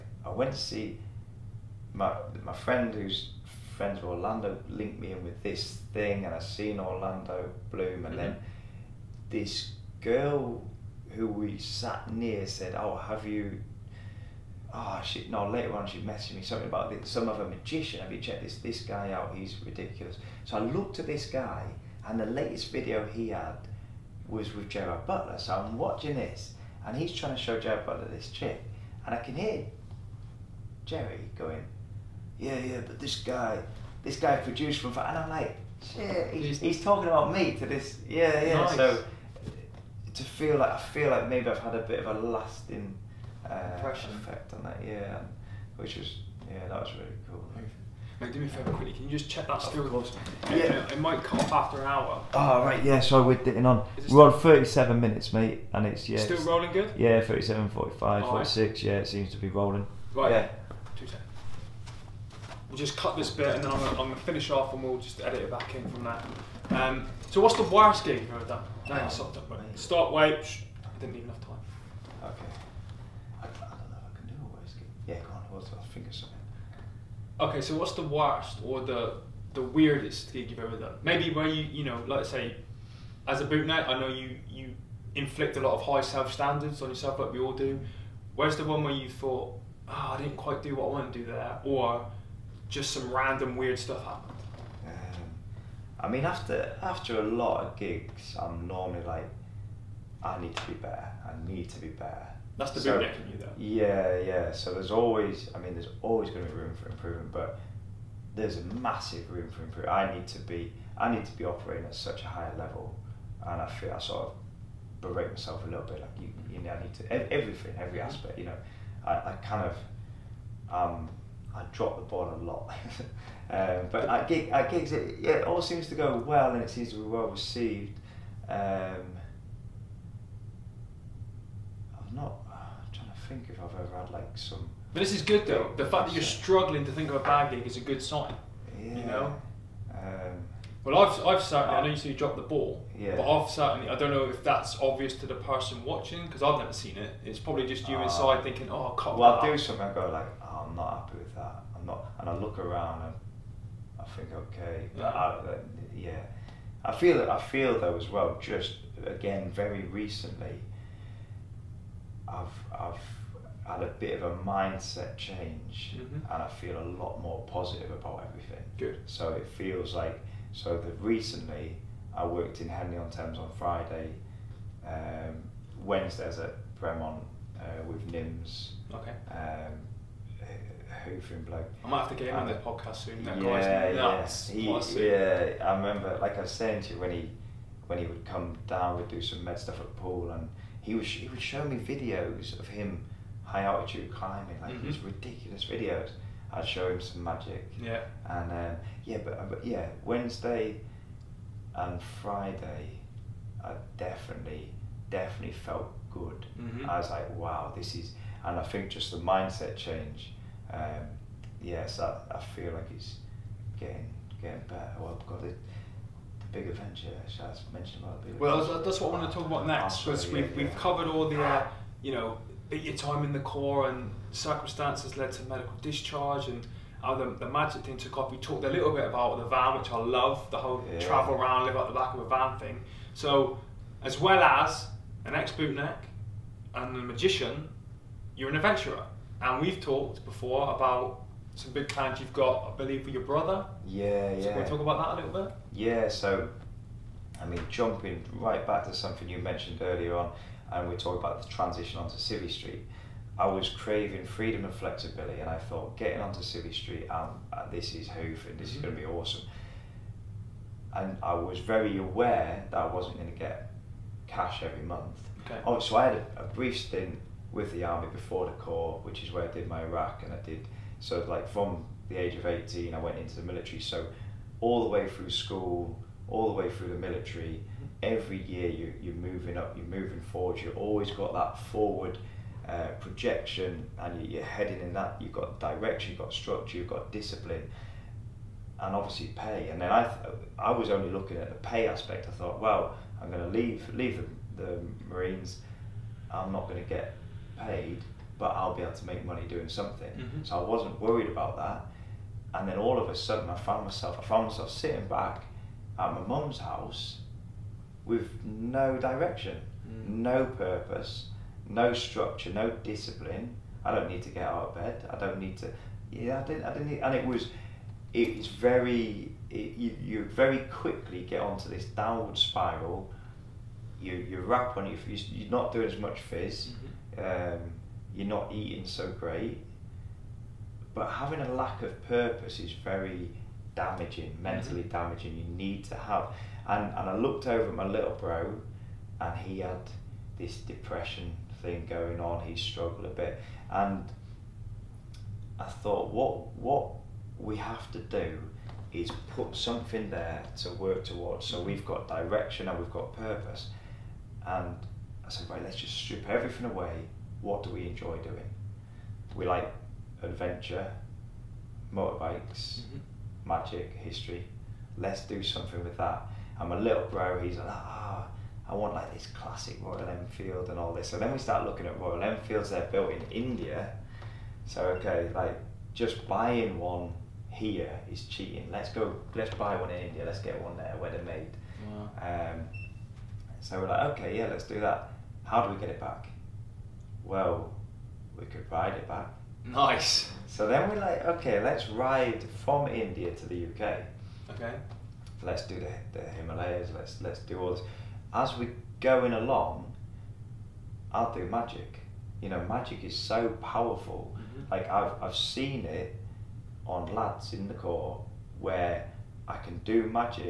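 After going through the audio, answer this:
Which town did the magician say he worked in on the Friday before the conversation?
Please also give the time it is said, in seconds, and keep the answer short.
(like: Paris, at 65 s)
Henley on Thames, at 172 s.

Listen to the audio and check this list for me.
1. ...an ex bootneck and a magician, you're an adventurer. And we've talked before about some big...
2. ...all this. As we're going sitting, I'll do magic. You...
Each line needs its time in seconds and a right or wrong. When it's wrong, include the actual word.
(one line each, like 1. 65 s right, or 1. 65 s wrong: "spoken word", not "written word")
1. 235 s right
2. 397 s wrong: "along", not "sitting".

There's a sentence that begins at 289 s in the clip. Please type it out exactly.
And then I, th- I was only looking at the pay aspect.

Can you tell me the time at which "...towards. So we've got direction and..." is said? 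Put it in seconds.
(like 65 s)
351 s.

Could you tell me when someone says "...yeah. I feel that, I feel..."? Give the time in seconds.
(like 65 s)
155 s.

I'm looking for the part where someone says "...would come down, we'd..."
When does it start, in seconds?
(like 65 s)
188 s.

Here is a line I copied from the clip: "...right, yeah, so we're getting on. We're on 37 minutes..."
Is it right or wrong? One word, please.
right.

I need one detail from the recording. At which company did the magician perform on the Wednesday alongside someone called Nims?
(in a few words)
Bremont.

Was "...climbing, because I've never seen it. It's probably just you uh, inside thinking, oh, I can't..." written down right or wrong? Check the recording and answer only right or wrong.
wrong.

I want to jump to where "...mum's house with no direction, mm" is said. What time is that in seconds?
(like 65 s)
306 s.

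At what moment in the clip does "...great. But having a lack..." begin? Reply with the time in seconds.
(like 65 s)
329 s.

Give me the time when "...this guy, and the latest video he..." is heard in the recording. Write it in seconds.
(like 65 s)
21 s.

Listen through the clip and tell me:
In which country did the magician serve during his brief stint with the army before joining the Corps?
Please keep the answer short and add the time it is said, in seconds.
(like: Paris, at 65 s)
Iraq, at 269 s.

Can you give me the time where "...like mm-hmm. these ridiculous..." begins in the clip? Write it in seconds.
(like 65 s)
194 s.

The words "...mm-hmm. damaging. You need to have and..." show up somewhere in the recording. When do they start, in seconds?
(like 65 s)
334 s.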